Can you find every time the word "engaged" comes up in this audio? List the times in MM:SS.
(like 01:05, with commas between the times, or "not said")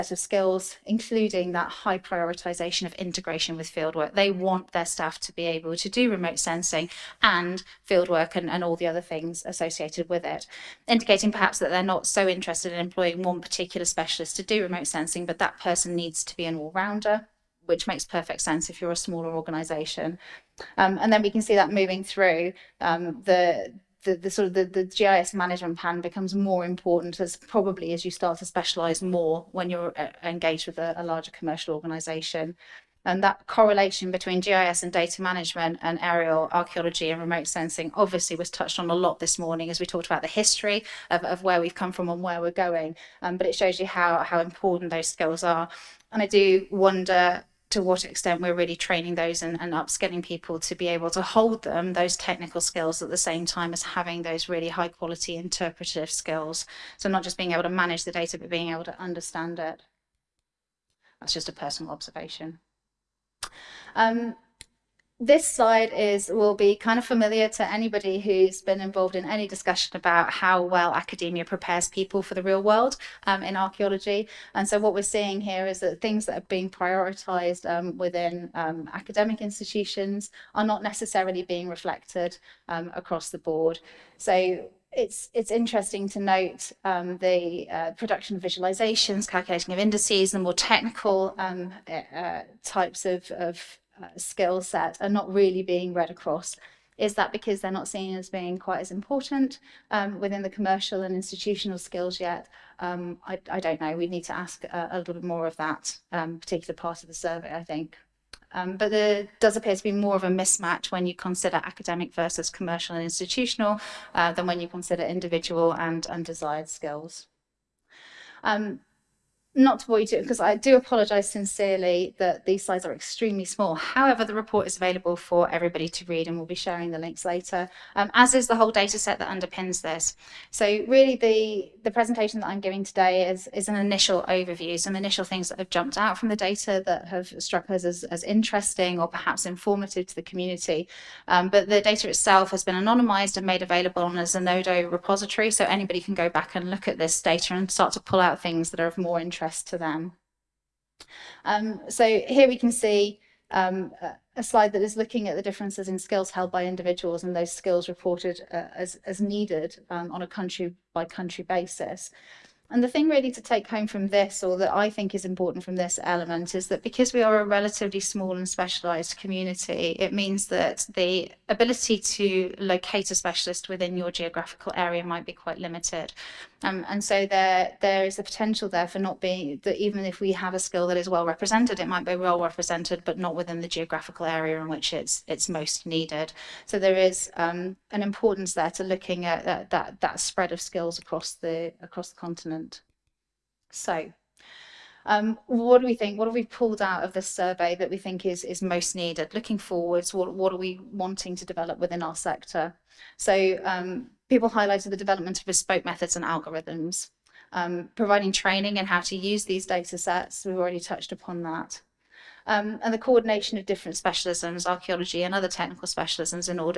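00:30.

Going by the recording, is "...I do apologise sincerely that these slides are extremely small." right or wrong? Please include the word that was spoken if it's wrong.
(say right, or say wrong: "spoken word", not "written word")
right.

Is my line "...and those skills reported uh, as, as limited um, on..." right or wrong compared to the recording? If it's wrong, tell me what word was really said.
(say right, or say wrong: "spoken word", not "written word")
wrong: "needed", not "limited".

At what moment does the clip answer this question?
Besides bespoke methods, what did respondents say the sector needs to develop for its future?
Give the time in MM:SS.
03:26.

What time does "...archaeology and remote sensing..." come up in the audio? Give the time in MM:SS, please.
00:36.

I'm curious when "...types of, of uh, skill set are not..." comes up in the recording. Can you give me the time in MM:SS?
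01:32.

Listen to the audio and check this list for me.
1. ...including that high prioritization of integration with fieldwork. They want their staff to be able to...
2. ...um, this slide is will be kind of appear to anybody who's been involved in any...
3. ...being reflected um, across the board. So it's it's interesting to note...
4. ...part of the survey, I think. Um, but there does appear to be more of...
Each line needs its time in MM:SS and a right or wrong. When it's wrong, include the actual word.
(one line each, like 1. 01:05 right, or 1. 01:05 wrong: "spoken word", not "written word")
1. 00:00 right
2. 01:03 wrong: "familiar", not "appear"
3. 01:21 right
4. 01:46 right.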